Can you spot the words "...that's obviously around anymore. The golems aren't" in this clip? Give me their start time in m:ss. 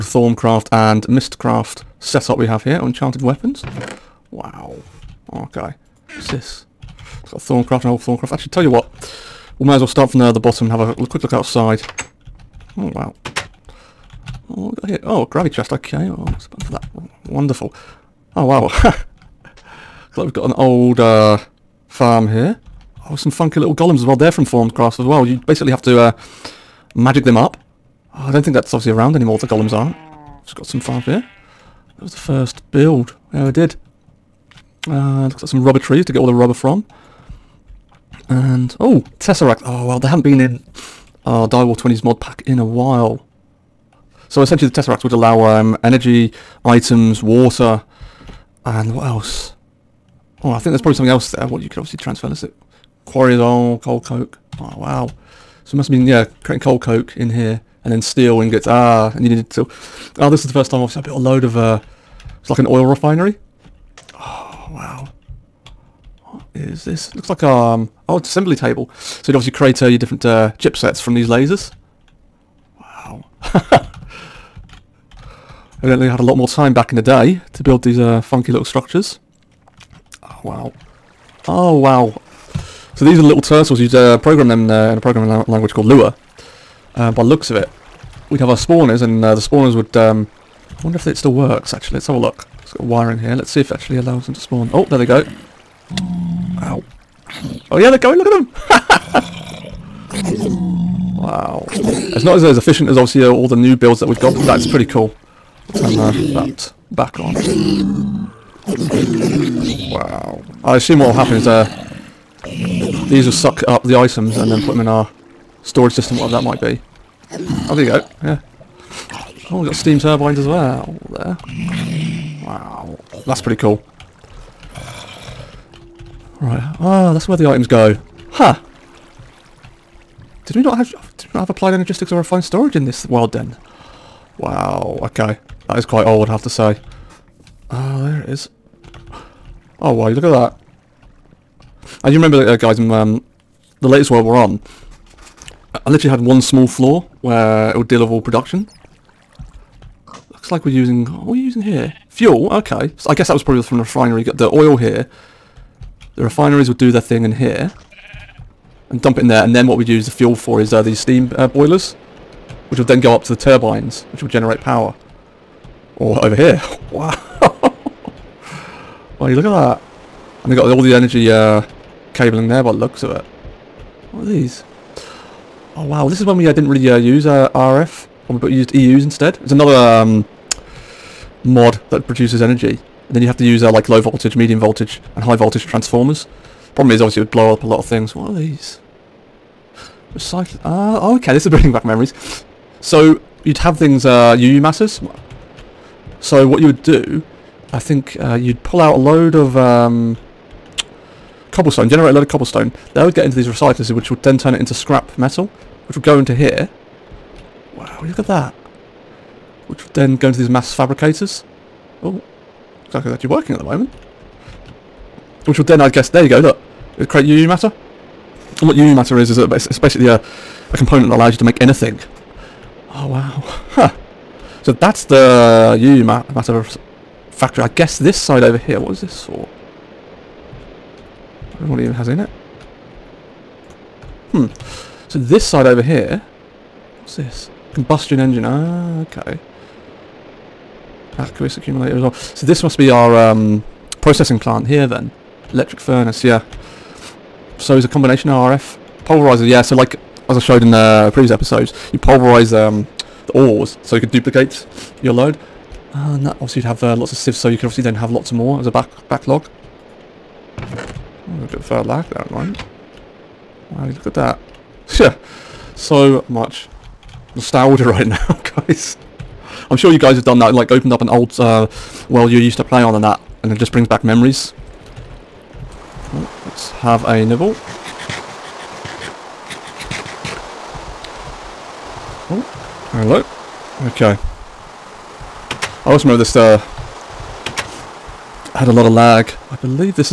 0:28.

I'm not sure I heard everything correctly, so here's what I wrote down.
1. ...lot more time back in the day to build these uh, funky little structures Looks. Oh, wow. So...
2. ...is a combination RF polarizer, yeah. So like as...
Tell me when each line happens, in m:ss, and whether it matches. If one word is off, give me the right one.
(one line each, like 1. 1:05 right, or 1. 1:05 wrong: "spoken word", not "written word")
1. 1:16 wrong: "Wow", not "Looks"
2. 4:07 right.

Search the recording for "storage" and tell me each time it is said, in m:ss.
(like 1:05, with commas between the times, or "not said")
1:55, 2:12.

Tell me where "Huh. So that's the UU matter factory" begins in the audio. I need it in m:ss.
3:43.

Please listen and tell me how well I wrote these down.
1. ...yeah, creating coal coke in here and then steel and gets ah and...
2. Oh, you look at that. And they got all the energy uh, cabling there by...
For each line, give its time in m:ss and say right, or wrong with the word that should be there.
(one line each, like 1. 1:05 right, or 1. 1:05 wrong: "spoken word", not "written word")
1. 0:56 right
2. 2:49 right.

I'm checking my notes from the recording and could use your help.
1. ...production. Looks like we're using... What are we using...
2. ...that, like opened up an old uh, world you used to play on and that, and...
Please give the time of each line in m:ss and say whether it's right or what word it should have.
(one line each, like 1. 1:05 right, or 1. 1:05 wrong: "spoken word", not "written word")
1. 2:28 right
2. 4:30 right.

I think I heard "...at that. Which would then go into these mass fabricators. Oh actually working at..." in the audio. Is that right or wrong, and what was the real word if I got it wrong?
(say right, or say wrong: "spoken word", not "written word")
right.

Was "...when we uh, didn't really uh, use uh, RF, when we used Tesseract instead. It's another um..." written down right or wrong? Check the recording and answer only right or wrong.
wrong.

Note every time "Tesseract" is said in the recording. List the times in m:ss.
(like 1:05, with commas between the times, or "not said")
0:39, 0:44.